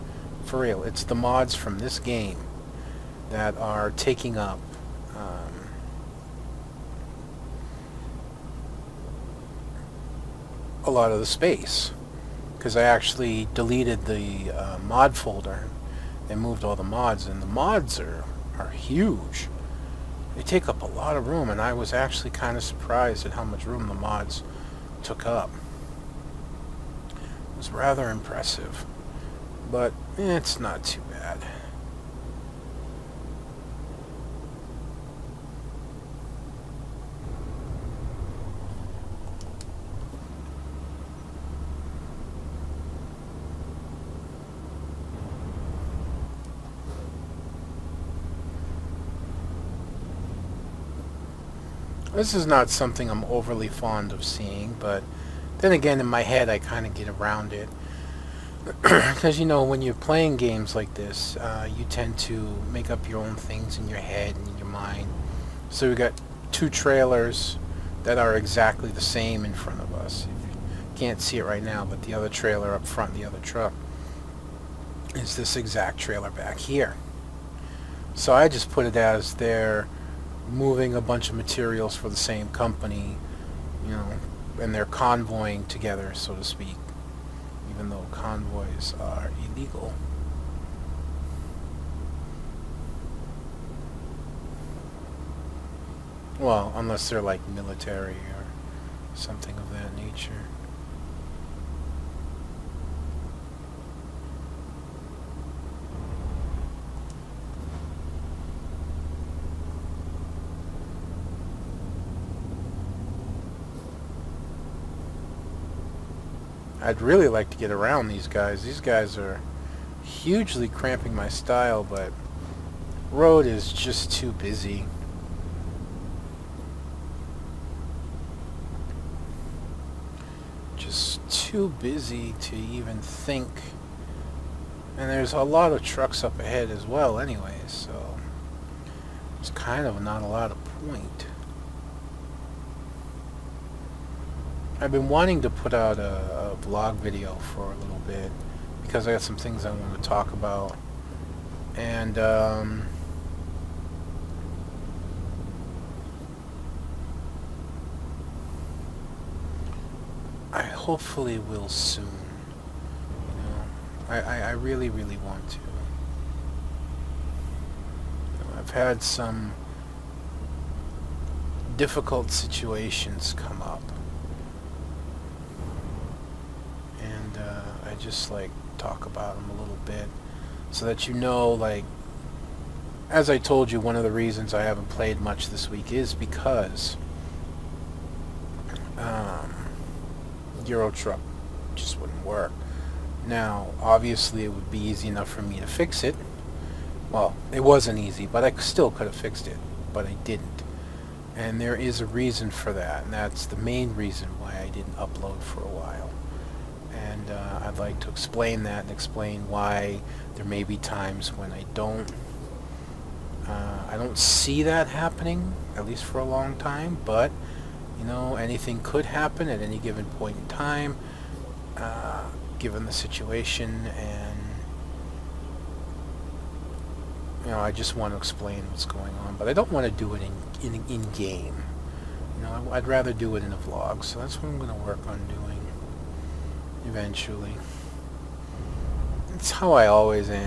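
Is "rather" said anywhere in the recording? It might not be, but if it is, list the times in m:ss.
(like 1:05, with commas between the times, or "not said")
0:27, 3:52.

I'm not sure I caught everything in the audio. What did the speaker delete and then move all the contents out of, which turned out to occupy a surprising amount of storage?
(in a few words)
mod folder.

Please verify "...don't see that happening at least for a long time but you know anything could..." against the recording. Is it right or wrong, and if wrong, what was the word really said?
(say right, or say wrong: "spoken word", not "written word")
right.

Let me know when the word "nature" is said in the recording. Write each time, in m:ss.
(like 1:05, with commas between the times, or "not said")
1:39.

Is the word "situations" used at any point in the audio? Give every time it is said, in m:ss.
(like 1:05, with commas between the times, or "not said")
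2:52, 3:42.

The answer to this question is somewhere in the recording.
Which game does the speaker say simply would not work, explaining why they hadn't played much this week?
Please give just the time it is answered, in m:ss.
3:10.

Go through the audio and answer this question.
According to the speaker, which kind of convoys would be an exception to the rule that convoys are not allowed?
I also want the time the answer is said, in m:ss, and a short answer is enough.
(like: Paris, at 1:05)
military, at 1:37.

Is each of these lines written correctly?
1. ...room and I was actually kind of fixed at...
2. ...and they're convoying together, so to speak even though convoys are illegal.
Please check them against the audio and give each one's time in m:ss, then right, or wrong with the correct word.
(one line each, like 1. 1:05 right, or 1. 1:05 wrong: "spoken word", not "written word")
1. 0:21 wrong: "surprised", not "fixed"
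2. 1:24 right.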